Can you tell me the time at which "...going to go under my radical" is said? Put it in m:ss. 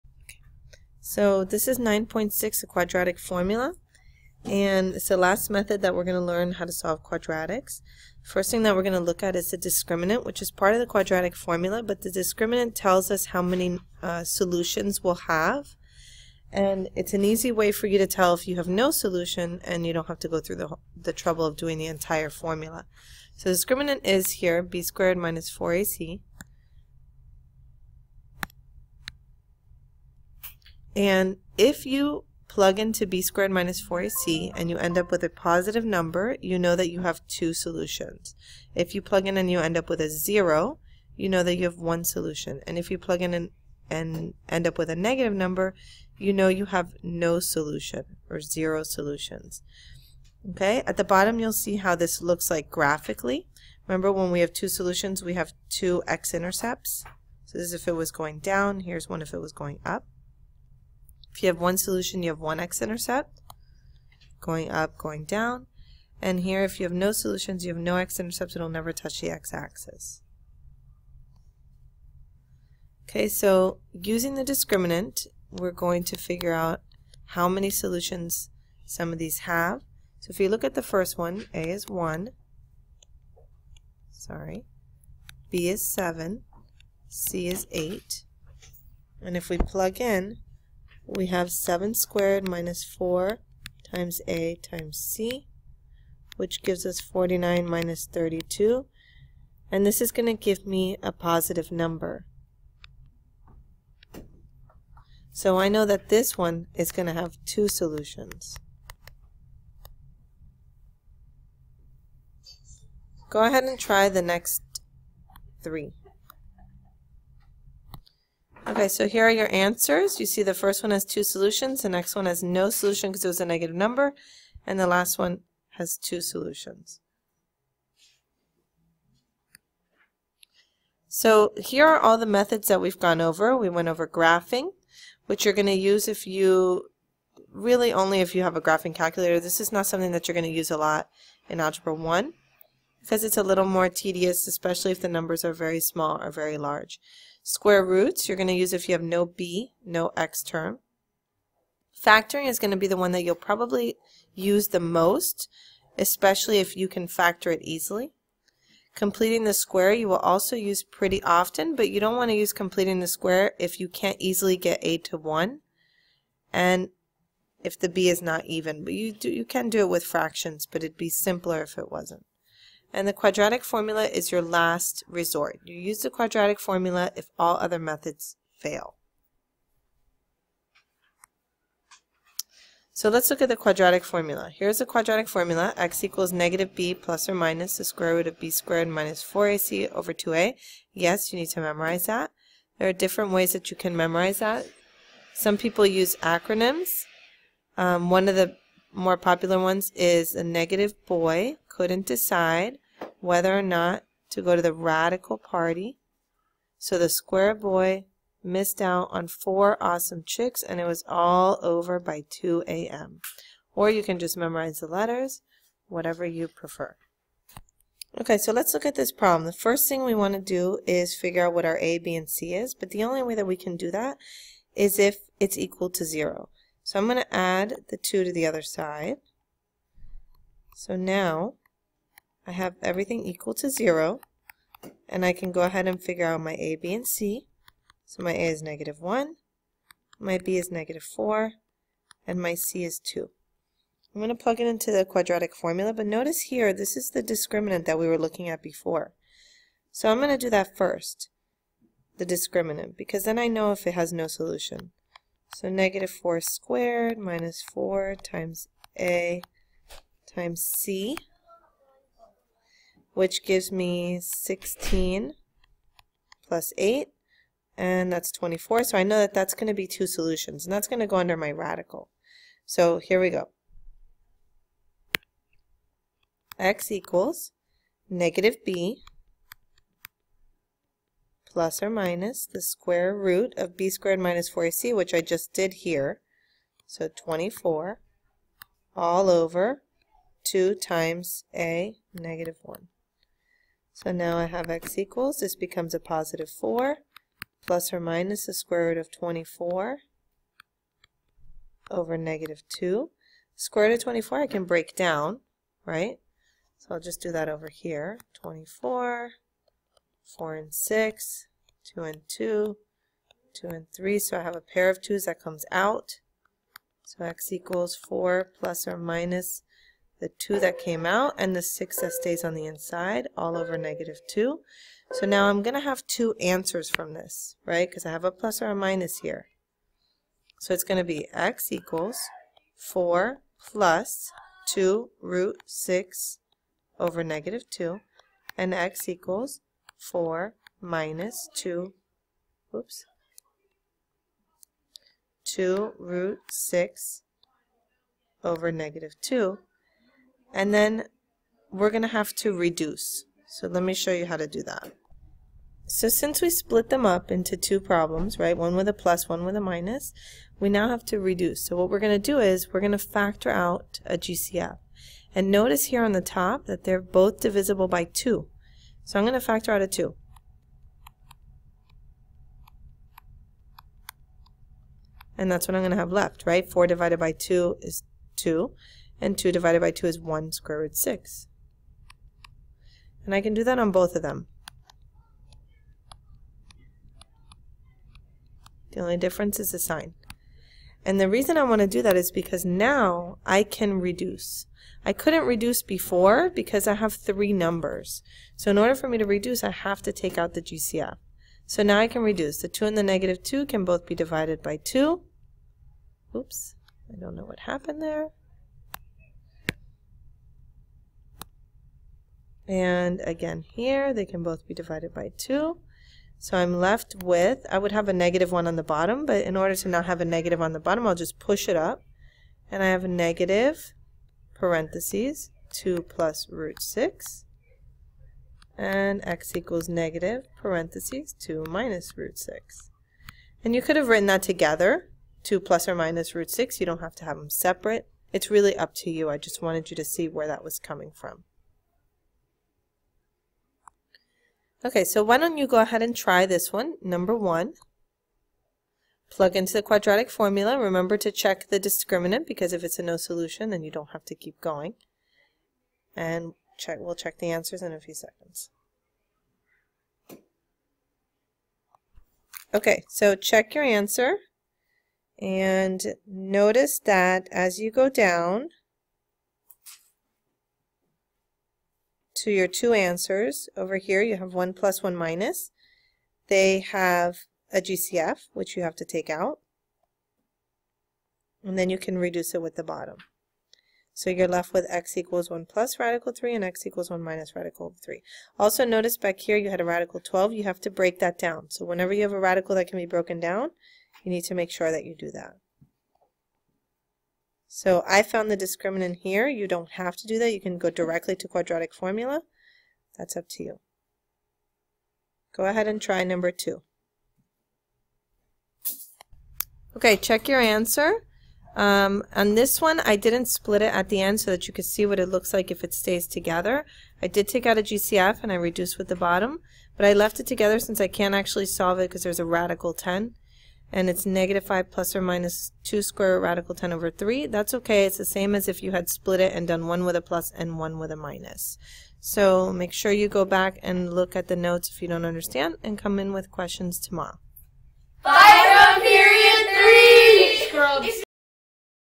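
4:30.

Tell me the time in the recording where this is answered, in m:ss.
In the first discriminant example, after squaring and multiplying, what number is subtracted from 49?
1:38.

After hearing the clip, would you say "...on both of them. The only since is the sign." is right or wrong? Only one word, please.
wrong.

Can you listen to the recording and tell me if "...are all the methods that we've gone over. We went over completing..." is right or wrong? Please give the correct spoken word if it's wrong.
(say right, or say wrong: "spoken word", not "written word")
wrong: "graphing", not "completing".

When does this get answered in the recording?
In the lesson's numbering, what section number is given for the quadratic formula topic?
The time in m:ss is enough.
0:01.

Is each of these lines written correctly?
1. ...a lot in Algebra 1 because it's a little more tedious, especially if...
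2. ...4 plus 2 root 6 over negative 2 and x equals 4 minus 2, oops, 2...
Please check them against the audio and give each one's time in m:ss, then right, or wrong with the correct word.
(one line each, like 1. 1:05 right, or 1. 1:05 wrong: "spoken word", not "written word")
1. 2:20 right
2. 5:32 right.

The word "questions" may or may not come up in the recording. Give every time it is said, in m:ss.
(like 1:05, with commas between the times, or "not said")
8:56.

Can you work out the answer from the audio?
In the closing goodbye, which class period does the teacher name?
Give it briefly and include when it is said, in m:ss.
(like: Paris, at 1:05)
period 3, at 8:59.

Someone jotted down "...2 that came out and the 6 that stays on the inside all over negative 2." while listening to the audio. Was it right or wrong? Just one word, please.
right.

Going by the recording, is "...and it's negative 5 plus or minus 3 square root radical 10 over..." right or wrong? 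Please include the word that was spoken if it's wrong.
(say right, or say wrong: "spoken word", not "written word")
wrong: "2", not "3".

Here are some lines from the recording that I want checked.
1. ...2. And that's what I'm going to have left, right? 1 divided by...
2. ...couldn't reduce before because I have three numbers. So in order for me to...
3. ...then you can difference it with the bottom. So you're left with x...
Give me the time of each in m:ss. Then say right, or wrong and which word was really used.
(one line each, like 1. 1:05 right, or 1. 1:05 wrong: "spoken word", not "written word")
1. 6:09 wrong: "4", not "1"
2. 6:35 right
3. 8:01 wrong: "reduce", not "difference".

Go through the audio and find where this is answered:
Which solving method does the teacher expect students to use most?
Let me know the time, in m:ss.
2:31.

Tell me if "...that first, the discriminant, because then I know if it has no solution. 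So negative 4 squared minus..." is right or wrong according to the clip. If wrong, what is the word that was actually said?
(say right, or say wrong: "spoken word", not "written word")
right.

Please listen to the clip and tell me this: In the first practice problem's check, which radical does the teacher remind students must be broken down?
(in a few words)
radical 12.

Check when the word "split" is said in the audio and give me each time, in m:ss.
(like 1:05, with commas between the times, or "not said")
5:56, 8:33, 8:49.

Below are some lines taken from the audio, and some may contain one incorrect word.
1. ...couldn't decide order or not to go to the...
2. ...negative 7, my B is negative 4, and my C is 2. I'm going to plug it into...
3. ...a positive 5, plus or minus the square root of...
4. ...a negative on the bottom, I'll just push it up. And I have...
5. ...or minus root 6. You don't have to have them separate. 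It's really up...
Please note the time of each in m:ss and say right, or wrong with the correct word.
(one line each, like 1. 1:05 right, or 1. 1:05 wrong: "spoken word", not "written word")
1. 3:21 wrong: "whether", not "order"
2. 3:58 wrong: "1", not "7"
3. 4:55 wrong: "4", not "5"
4. 7:00 right
5. 7:15 right.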